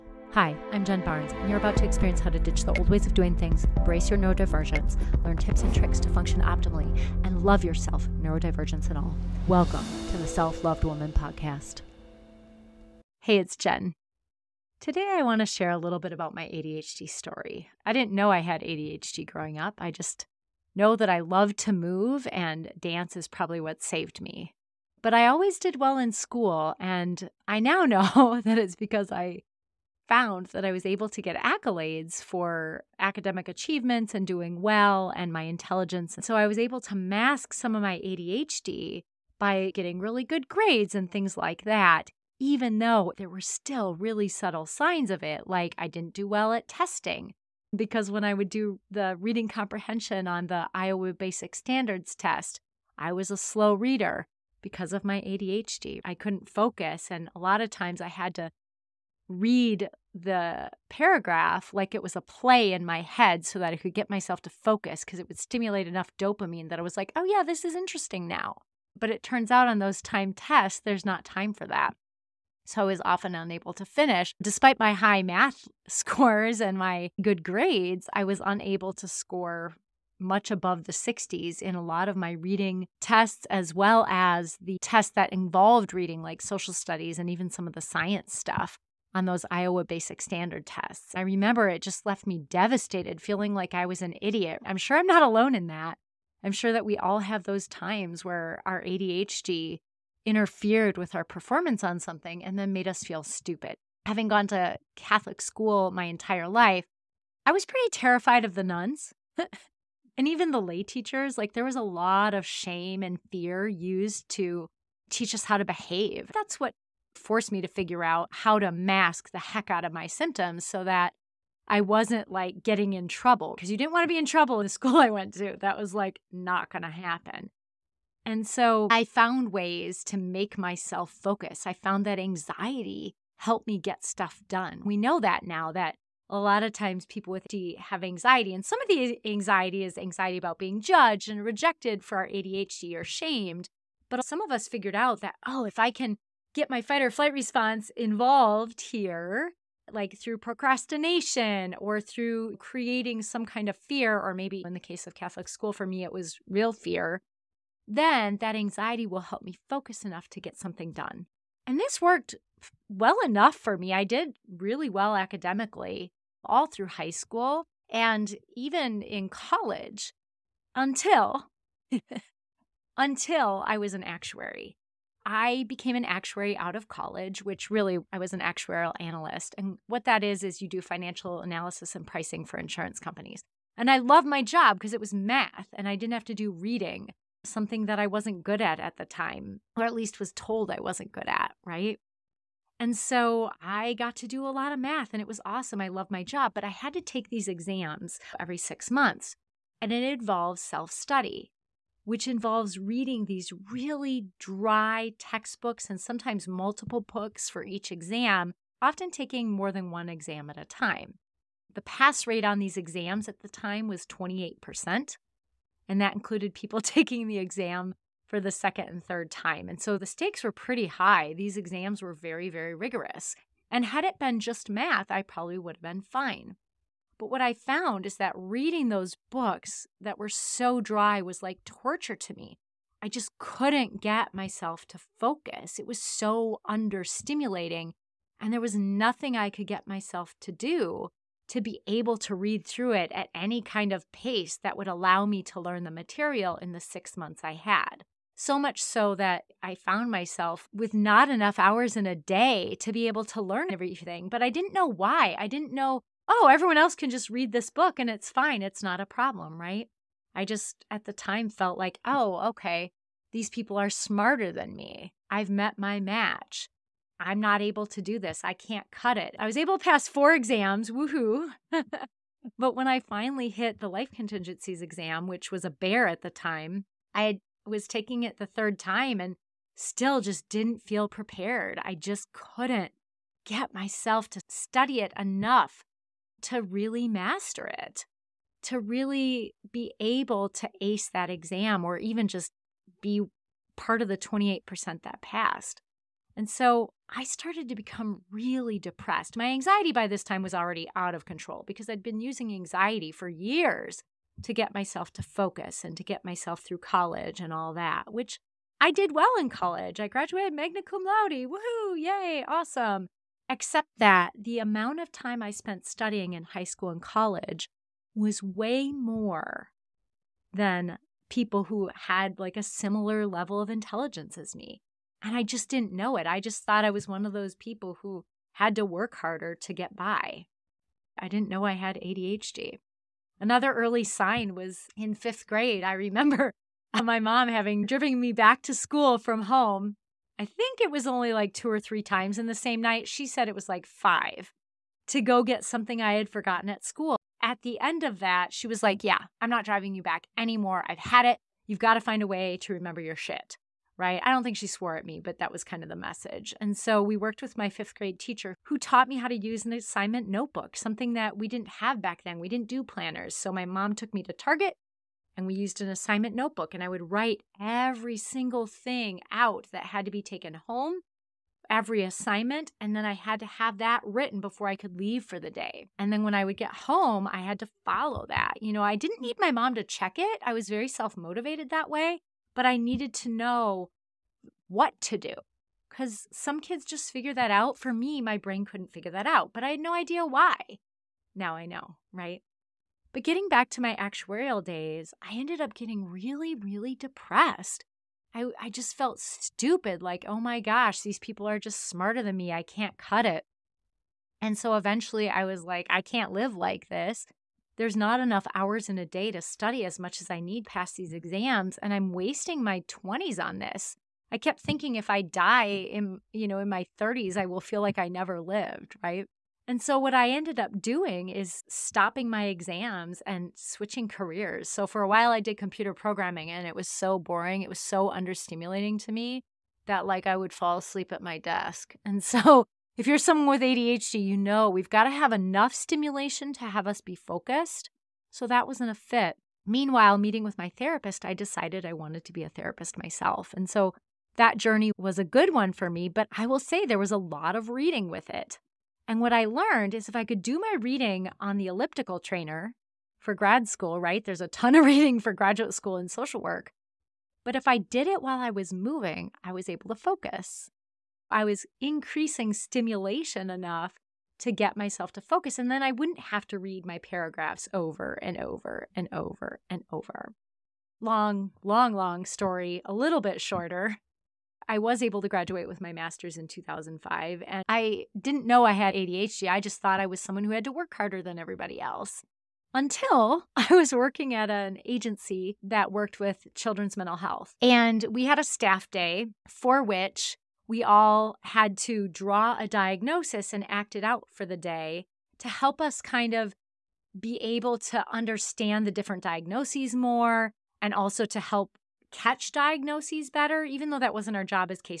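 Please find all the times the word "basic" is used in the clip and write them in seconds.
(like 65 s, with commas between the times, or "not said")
51 s, 89 s.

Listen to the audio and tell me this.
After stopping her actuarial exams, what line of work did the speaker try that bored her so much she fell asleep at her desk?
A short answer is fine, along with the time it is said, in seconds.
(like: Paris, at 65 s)
computer programming, at 425 s.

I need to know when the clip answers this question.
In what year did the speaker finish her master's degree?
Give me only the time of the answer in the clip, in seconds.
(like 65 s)
476 s.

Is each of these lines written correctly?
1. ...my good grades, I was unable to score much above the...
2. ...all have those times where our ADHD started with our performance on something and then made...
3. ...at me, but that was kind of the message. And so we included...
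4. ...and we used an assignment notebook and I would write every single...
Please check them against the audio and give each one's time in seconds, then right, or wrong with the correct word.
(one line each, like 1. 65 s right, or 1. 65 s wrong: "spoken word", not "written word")
1. 76 s right
2. 96 s wrong: "interfered", not "started"
3. 354 s wrong: "worked", not "included"
4. 365 s right.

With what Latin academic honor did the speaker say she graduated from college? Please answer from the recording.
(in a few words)
magna cum laude.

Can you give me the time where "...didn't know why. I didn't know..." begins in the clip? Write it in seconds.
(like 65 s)
254 s.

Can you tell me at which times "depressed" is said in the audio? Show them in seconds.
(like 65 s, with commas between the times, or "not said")
298 s, 396 s.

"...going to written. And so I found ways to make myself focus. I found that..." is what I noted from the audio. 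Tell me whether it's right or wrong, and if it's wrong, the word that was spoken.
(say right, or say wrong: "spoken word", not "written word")
wrong: "happen", not "written".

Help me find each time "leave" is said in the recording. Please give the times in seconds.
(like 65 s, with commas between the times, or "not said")
374 s.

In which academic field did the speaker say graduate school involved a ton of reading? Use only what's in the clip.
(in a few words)
social work.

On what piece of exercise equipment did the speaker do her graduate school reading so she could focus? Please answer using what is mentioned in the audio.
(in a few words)
elliptical trainer.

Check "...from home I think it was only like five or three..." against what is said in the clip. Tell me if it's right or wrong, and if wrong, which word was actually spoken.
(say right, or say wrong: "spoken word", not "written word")
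wrong: "two", not "five".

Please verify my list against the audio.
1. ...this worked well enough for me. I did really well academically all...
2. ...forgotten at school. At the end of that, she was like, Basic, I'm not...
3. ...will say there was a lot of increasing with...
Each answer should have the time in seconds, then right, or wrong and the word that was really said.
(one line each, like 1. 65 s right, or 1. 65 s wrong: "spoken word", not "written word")
1. 161 s right
2. 346 s wrong: "Yeah", not "Basic"
3. 446 s wrong: "reading", not "increasing".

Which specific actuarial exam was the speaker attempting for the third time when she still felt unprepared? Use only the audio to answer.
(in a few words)
life contingencies.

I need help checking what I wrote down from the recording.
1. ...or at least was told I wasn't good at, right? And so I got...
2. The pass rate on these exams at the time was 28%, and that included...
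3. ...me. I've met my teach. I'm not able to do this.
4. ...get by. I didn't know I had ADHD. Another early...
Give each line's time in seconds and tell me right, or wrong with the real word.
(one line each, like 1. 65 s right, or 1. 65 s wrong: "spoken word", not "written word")
1. 189 s right
2. 211 s right
3. 264 s wrong: "match", not "teach"
4. 329 s right.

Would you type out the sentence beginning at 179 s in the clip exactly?
And what that is, is you do financial analysis and pricing for insurance companies.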